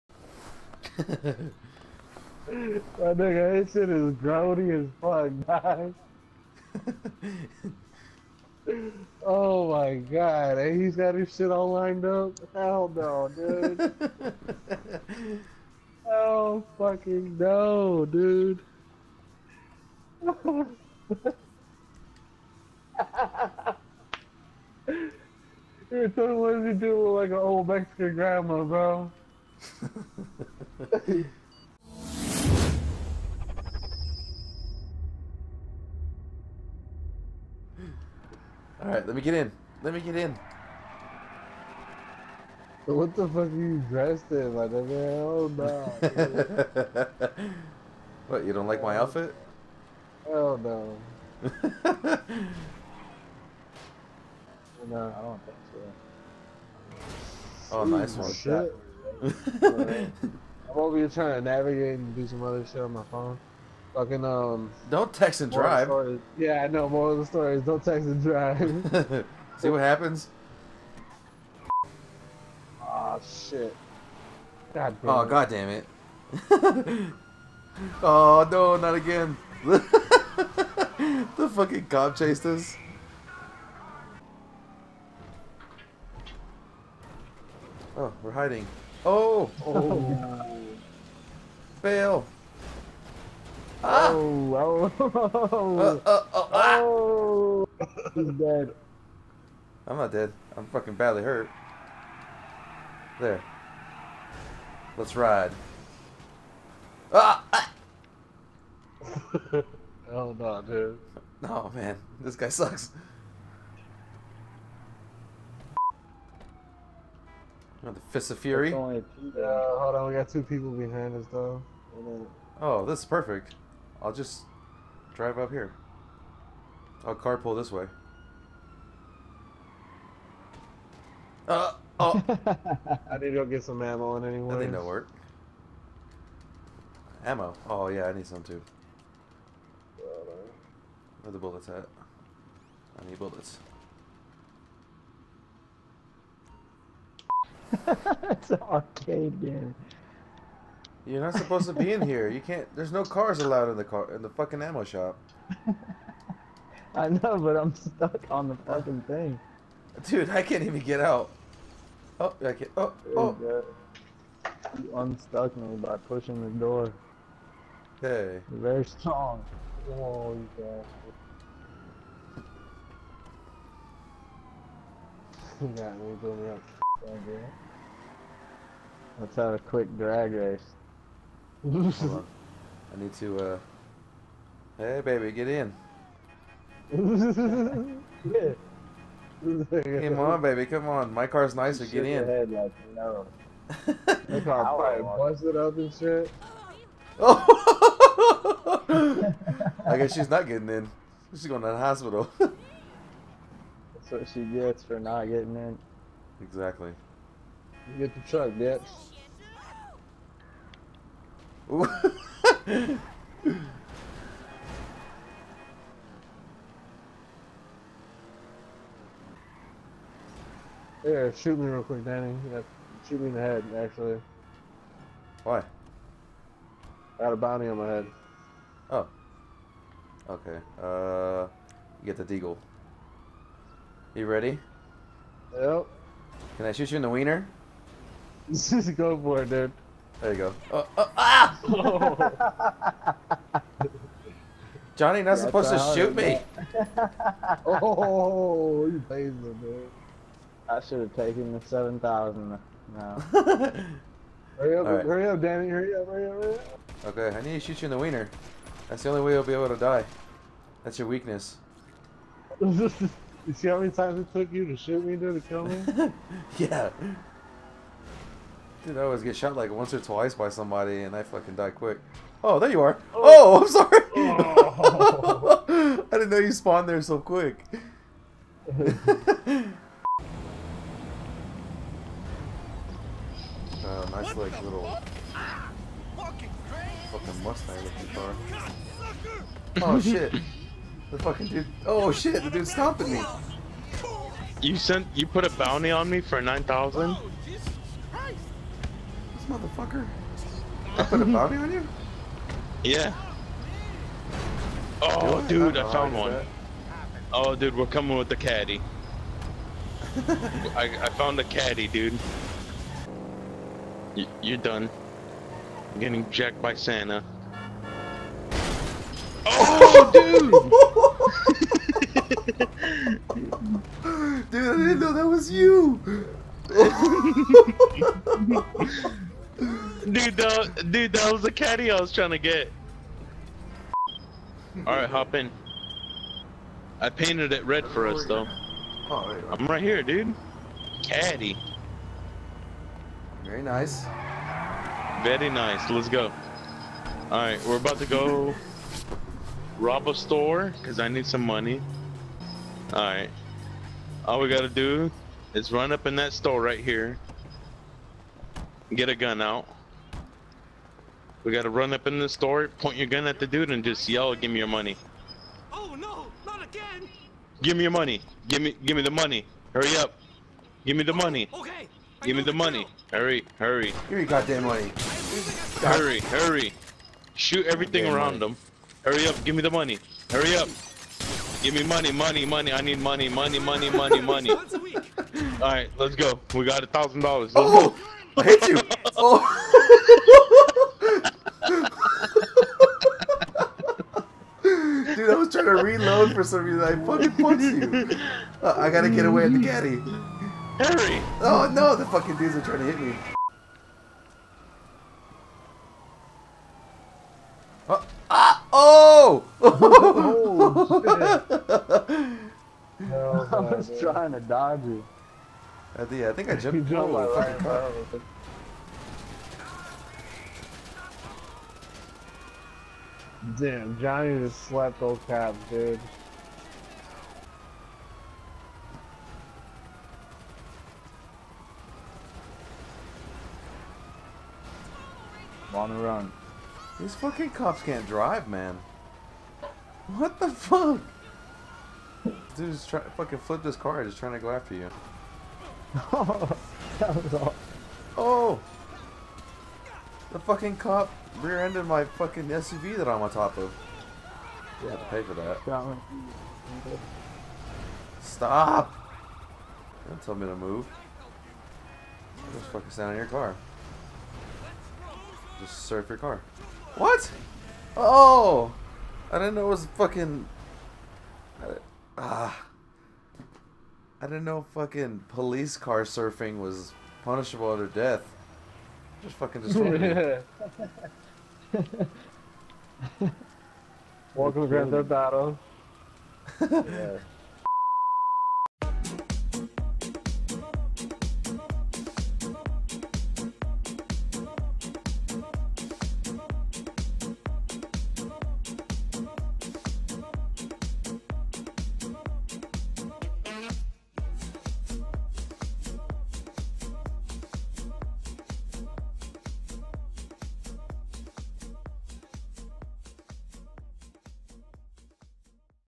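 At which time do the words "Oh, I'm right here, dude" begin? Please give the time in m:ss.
5:39.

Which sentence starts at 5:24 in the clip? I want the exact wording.
dude, I didn't know that was you!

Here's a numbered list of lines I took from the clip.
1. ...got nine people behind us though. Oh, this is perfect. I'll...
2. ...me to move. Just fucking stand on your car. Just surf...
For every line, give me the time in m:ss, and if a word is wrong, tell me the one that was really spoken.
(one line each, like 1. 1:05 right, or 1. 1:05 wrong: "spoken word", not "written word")
1. 2:00 wrong: "two", not "nine"
2. 7:40 right.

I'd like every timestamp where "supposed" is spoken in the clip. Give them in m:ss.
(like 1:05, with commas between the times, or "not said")
2:31, 4:05.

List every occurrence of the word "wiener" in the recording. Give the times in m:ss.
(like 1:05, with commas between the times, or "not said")
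3:57, 4:17.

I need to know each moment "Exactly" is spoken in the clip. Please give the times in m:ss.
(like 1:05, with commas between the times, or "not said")
3:26.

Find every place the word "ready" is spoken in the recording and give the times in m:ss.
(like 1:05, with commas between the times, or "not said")
3:54.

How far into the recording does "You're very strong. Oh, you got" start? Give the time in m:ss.
2:48.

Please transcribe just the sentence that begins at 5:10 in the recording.
I, I found the caddy, dude.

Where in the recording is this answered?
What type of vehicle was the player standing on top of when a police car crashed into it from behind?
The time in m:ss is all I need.
7:32.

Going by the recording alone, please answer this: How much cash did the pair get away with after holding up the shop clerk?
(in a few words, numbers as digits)
a thousand dollars.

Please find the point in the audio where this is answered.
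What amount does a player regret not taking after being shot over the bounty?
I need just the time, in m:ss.
4:11.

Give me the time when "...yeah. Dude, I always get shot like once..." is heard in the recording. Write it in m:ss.
4:26.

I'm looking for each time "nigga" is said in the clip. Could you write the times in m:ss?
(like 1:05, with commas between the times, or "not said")
0:03, 0:44.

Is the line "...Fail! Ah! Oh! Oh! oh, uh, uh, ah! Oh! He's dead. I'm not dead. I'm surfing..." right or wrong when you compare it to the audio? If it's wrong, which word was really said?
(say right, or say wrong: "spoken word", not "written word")
wrong: "fucking", not "surfing".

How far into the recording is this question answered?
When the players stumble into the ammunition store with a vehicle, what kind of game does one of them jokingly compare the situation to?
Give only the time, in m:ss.
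2:28.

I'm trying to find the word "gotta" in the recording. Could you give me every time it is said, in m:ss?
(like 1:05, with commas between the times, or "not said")
5:54, 6:01, 6:38.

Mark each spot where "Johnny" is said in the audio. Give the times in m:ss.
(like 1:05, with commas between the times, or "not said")
4:04, 7:03.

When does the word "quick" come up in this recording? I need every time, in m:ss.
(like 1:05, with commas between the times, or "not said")
2:59, 3:41, 4:31, 4:37.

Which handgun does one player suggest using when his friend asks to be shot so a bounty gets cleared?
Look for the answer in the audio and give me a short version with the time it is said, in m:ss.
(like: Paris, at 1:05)
deagle, at 3:52.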